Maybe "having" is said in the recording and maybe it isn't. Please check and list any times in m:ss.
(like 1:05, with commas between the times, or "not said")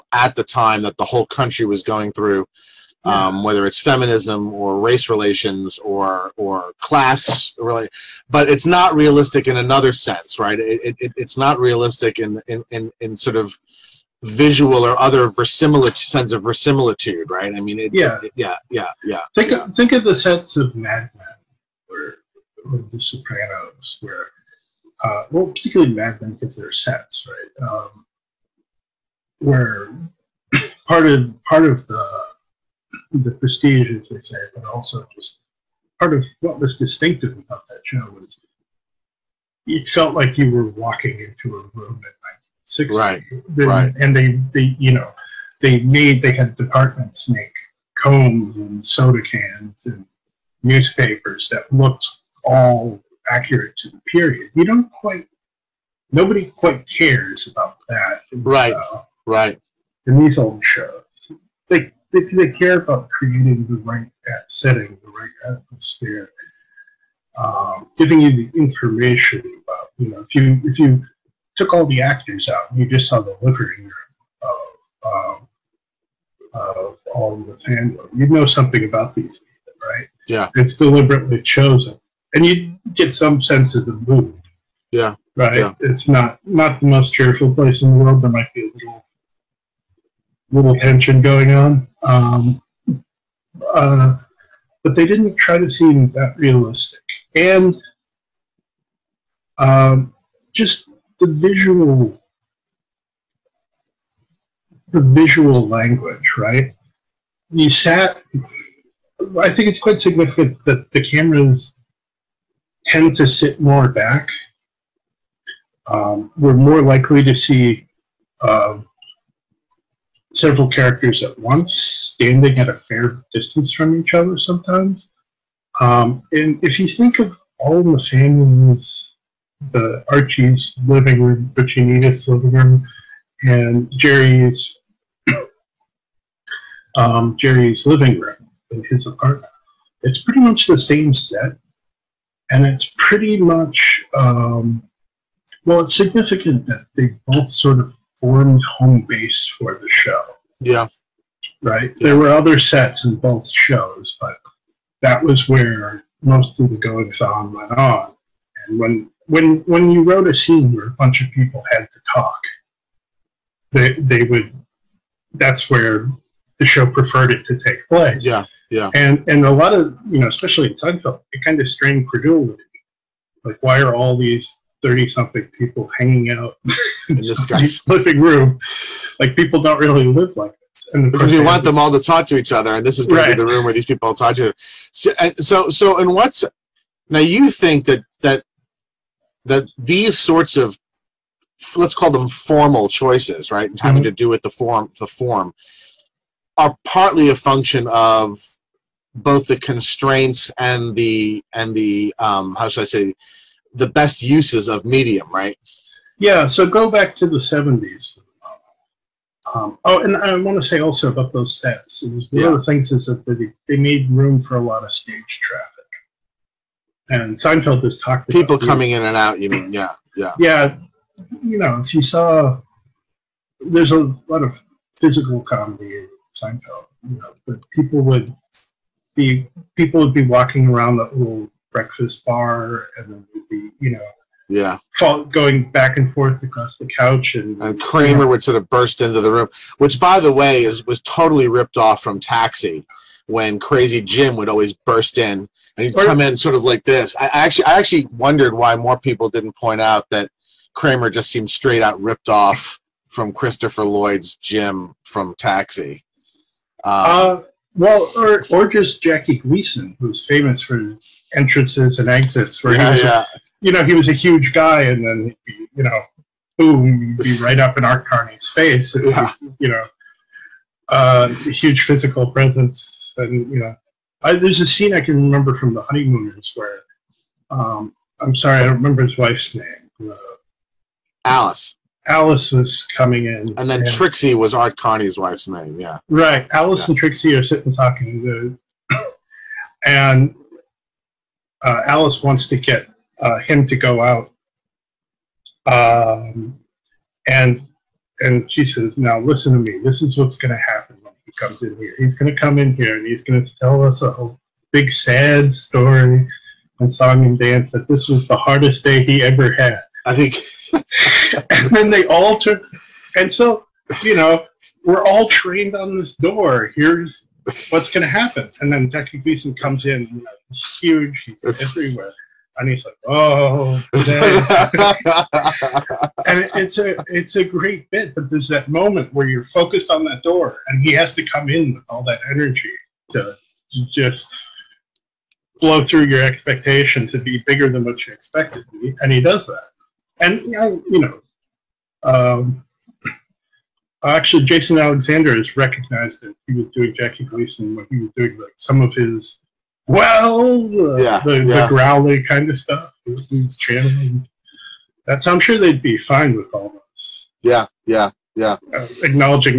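3:13.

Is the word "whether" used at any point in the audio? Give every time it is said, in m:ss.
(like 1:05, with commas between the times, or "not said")
0:03.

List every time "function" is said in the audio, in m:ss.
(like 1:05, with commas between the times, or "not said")
3:17.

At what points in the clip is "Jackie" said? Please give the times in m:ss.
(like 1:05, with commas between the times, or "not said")
4:19, 5:18, 5:46.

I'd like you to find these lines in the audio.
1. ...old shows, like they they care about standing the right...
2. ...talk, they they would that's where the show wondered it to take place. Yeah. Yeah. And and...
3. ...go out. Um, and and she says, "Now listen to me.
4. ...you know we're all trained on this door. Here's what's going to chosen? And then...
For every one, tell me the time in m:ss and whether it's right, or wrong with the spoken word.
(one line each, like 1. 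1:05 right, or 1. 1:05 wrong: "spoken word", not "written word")
1. 1:00 wrong: "creating", not "standing"
2. 2:42 wrong: "preferred", not "wondered"
3. 4:53 right
4. 5:14 wrong: "happen", not "chosen".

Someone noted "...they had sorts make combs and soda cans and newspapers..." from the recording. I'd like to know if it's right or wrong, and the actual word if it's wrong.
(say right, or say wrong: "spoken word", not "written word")
wrong: "departments", not "sorts".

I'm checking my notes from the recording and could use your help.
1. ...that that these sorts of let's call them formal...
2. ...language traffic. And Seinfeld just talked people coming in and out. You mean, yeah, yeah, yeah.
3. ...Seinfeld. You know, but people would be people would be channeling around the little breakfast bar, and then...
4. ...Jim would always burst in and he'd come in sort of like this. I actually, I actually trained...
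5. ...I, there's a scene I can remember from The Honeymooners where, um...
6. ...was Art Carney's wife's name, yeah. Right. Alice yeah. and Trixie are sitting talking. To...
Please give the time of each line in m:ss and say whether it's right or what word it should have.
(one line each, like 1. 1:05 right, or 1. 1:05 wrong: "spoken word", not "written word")
1. 3:08 right
2. 3:34 wrong: "stage", not "language"
3. 3:46 wrong: "walking", not "channeling"
4. 4:04 wrong: "wondered", not "trained"
5. 4:34 right
6. 4:44 right.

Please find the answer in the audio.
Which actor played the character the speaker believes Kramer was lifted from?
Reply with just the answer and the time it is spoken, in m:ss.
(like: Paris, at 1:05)
Christopher Lloyd, at 4:13.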